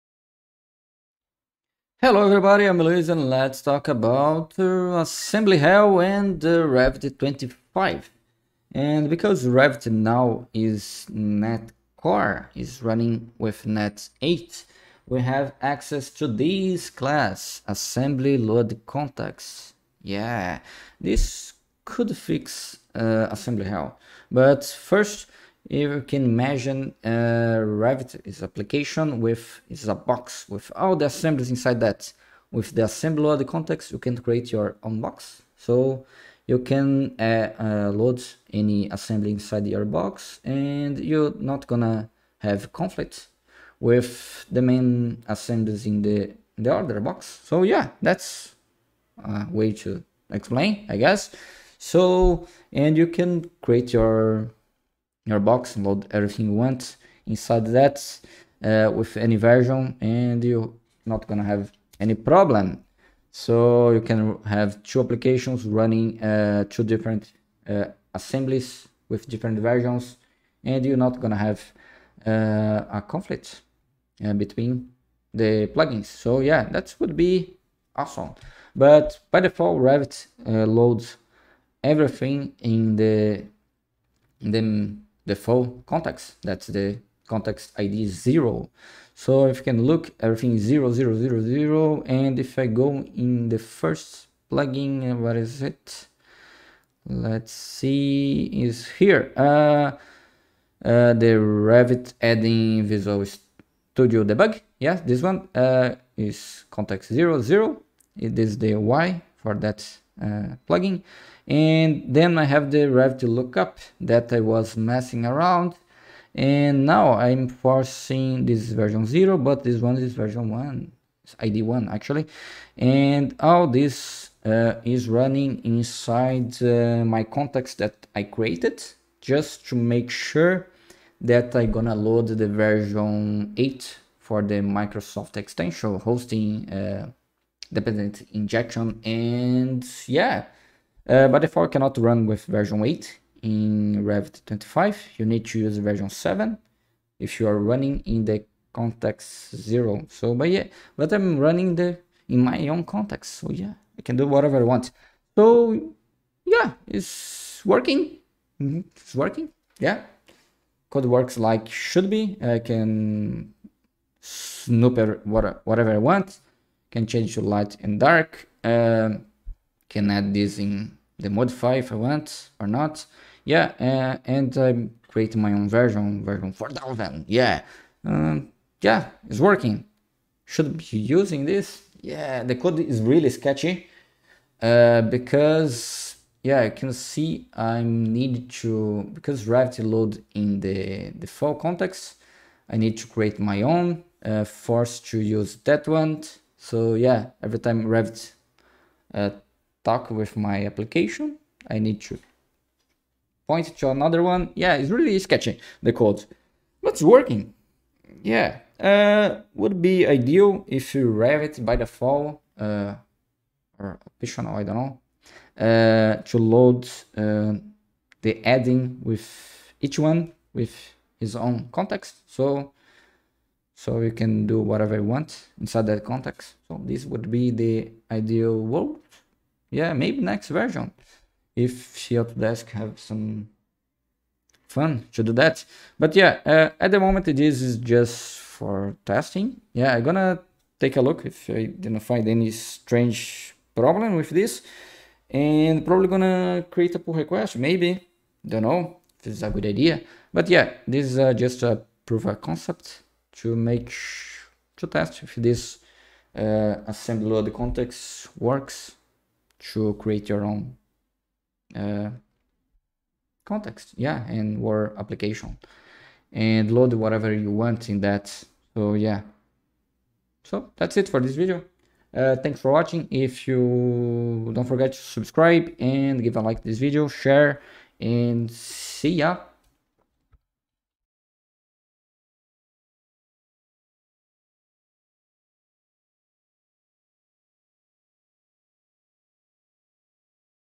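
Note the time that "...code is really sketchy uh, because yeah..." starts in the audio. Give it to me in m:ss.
3:02.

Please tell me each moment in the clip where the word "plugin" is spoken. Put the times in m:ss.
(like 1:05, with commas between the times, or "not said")
1:15, 1:34, 1:50.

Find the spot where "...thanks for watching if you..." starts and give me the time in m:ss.
4:32.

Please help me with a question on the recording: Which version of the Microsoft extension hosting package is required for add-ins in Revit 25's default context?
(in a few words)
7.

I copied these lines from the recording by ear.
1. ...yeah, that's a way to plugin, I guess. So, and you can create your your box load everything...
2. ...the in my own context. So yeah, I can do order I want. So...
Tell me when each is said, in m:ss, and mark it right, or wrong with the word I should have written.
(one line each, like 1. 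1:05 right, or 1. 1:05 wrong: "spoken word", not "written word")
1. 0:47 wrong: "explain", not "plugin"
2. 2:31 wrong: "whatever", not "order".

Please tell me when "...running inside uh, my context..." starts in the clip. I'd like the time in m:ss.
2:05.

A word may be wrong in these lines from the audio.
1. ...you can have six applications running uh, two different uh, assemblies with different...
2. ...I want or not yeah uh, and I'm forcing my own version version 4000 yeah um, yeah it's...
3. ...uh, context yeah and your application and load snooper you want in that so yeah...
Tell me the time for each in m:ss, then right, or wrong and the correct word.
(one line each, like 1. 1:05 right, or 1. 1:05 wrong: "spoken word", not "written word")
1. 1:03 wrong: "two", not "six"
2. 2:51 wrong: "creating", not "forcing"
3. 4:21 wrong: "whatever", not "snooper".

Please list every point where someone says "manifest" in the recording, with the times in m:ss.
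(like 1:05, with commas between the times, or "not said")
not said.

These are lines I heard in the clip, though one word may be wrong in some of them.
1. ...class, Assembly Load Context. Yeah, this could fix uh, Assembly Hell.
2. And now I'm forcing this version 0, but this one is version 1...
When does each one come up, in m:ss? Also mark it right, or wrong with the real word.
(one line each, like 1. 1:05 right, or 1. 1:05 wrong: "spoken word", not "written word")
1. 0:16 right
2. 1:56 right.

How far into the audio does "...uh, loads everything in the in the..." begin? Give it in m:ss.
1:20.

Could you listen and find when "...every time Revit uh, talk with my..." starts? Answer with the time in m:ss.
3:17.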